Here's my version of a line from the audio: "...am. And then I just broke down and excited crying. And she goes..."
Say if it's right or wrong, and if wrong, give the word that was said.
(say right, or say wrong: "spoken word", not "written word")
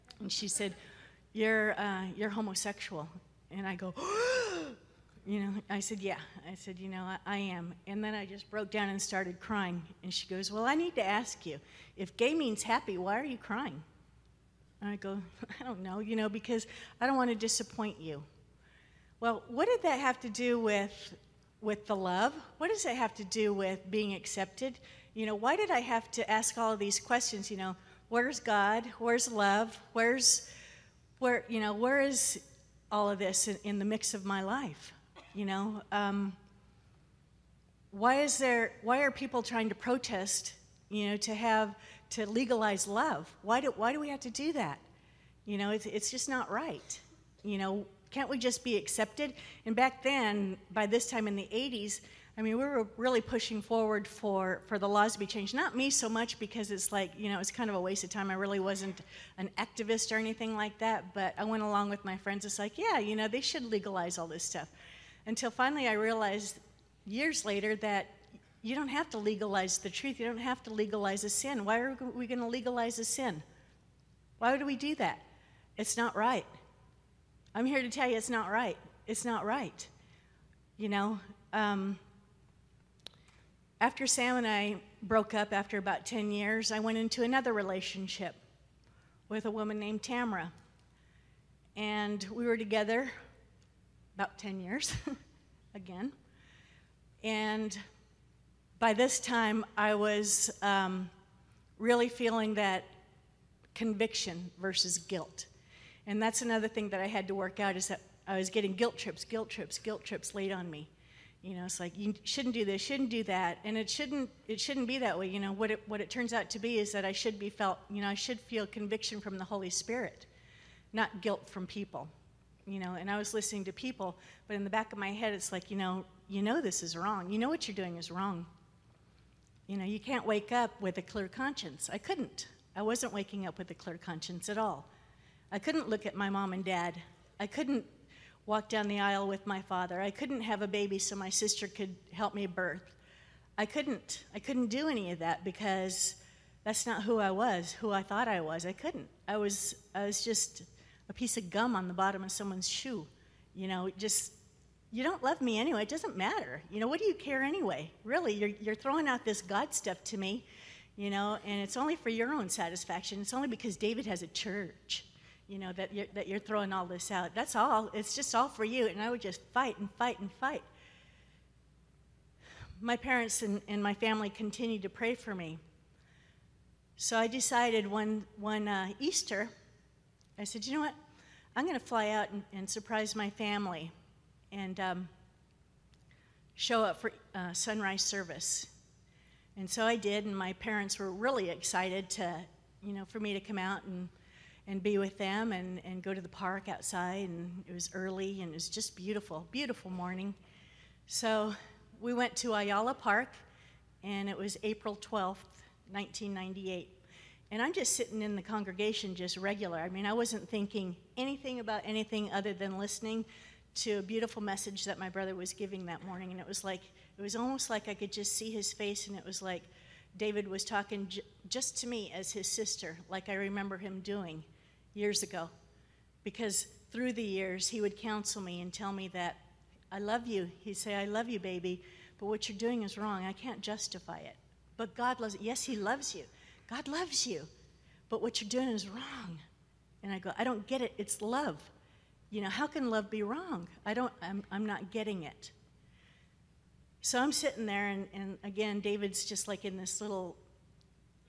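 wrong: "started", not "excited".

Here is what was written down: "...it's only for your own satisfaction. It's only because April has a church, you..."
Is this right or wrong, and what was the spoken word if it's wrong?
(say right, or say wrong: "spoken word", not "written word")
wrong: "David", not "April".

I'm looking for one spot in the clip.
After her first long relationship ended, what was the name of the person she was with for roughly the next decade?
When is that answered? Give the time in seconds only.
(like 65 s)
90 s.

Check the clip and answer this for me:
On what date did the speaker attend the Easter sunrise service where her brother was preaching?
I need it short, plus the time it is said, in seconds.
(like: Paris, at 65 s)
April 12, 1998, at 204 s.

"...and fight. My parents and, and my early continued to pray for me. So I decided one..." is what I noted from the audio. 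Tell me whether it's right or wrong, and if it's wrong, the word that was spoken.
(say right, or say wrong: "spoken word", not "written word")
wrong: "family", not "early".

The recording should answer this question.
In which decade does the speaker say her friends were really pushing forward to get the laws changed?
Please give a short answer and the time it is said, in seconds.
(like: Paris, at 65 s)
1980s, at 51 s.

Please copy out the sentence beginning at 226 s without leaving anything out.
Because through the years, he would counsel me and tell me that I love you.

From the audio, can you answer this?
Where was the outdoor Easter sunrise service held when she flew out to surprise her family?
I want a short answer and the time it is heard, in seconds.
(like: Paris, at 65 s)
Ayala Park, at 202 s.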